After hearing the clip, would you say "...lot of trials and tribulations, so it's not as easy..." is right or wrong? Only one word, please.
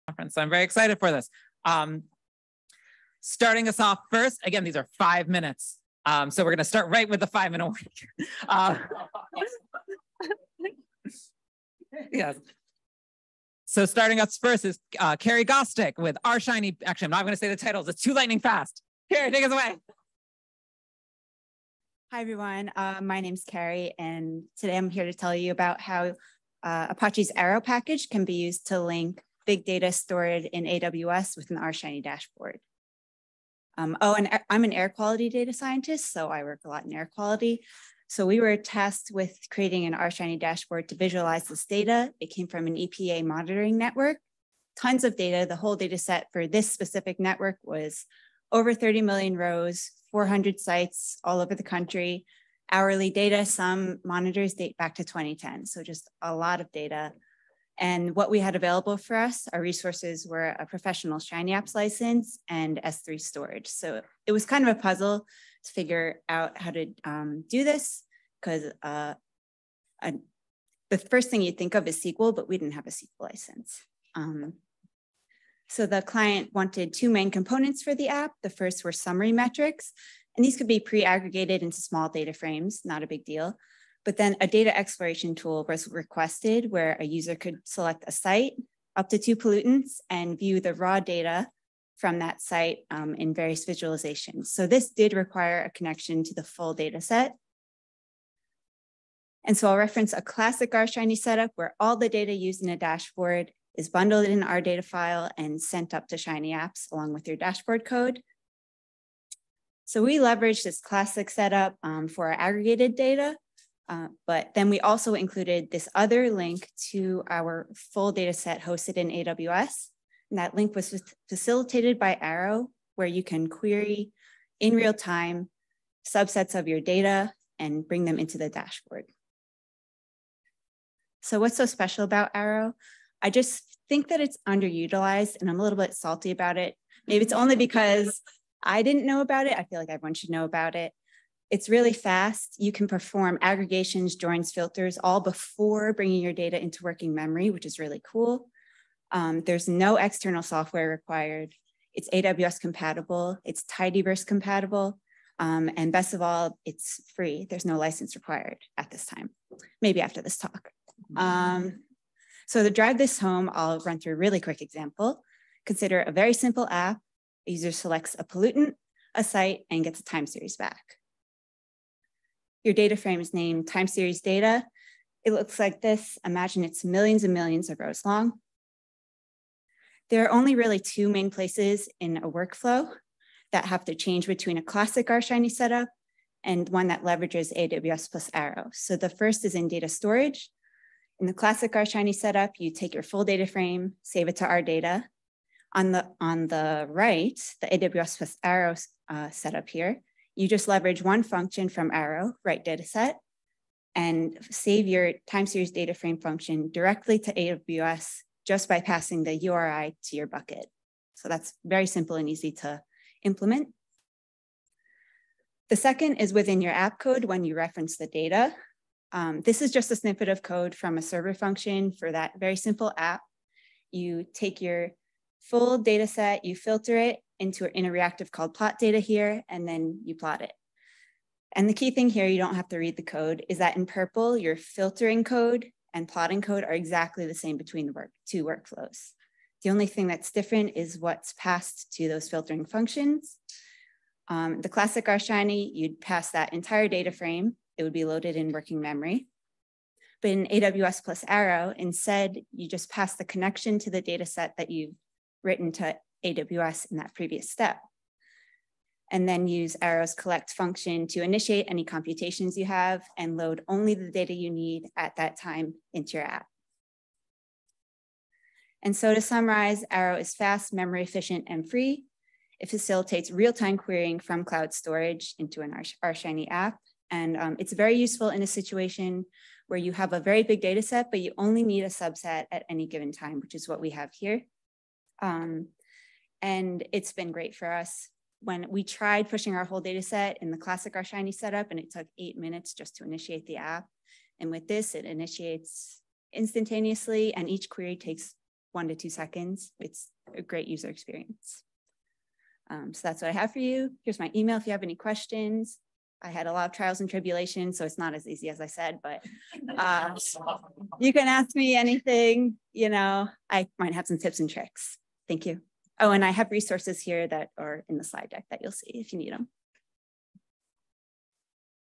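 right.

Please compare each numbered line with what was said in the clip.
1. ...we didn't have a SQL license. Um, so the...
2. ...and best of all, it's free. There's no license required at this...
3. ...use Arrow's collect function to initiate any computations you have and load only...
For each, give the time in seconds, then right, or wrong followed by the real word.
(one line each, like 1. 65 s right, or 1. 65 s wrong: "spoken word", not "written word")
1. 72 s right
2. 155 s right
3. 259 s right.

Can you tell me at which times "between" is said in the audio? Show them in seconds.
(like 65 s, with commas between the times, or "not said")
184 s, 237 s.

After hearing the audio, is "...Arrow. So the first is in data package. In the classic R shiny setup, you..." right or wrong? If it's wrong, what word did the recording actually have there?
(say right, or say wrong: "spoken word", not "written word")
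wrong: "storage", not "package".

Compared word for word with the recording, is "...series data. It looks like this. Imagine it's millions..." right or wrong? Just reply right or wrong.
right.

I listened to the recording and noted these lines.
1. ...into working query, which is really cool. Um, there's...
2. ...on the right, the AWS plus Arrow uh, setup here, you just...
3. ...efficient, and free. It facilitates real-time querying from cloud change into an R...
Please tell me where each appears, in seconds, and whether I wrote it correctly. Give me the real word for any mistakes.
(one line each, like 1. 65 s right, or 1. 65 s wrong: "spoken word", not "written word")
1. 146 s wrong: "memory", not "query"
2. 196 s right
3. 271 s wrong: "storage", not "change".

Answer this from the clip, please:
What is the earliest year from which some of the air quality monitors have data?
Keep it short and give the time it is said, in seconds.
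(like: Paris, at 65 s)
2010, at 55 s.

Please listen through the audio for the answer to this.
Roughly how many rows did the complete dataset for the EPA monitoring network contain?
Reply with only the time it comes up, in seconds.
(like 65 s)
48 s.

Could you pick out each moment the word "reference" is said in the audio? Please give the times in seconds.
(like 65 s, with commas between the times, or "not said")
99 s, 217 s.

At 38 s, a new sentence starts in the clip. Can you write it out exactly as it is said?
So we were tasked with creating an R Shiny dashboard to visualize this data.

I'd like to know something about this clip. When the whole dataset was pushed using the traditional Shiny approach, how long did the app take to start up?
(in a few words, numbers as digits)
8 minutes.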